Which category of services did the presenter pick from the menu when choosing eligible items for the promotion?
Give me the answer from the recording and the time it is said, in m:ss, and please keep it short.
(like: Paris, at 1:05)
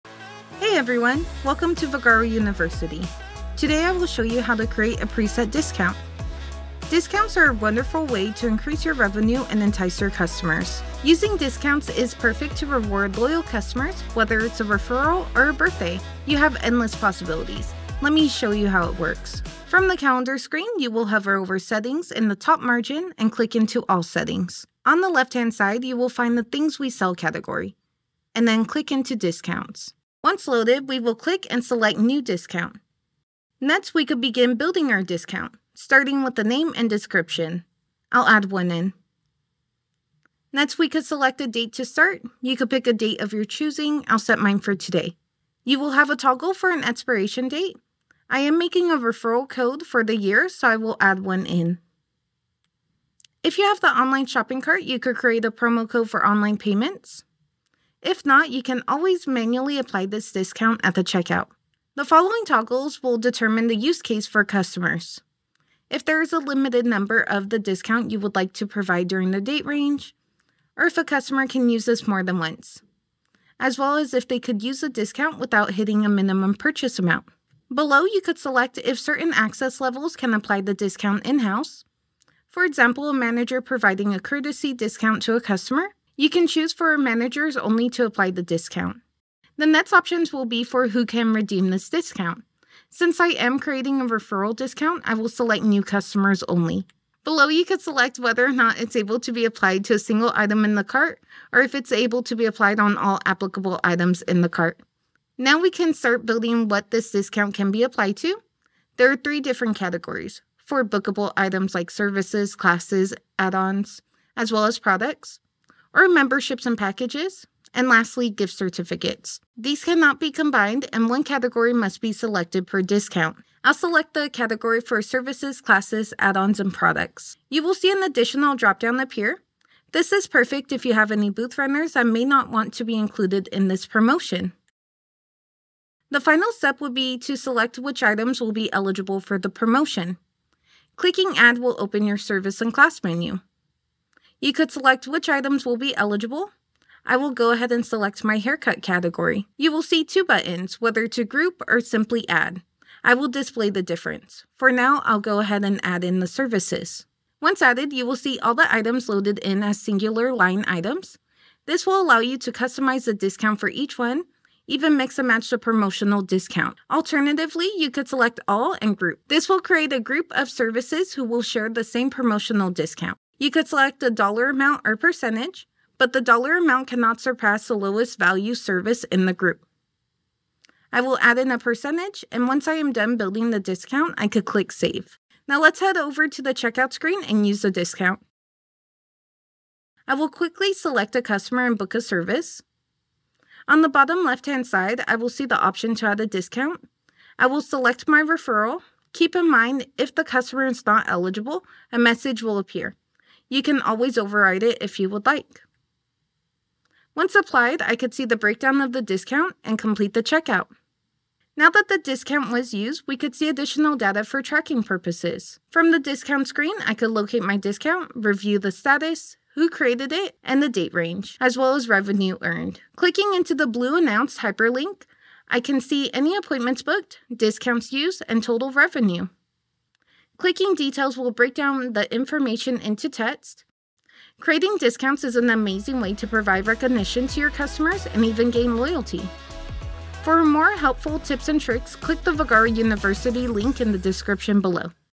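Haircut, at 2:28.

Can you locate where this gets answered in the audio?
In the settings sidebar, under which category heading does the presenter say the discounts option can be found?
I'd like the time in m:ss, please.
0:26.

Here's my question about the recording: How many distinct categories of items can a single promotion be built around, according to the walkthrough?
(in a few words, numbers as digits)
3.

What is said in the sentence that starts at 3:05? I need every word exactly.
Now let's head over to the checkout screen and use the discount.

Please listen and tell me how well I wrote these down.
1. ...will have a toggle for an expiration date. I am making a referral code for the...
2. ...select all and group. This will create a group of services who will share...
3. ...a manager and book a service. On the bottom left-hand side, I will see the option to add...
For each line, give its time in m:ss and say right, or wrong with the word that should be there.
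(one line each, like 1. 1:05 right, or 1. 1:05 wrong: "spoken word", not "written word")
1. 0:45 right
2. 2:48 right
3. 3:11 wrong: "customer", not "manager".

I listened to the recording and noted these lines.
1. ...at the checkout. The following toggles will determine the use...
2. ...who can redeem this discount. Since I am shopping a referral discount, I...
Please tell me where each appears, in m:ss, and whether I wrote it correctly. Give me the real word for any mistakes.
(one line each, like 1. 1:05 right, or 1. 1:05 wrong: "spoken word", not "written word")
1. 1:00 right
2. 1:30 wrong: "creating", not "shopping".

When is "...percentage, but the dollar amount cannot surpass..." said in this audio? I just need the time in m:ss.
2:54.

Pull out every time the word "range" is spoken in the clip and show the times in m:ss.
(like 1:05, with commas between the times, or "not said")
1:09, 3:40.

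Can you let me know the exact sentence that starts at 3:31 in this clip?
Now that the discount was used, we could see additional data for tracking purposes.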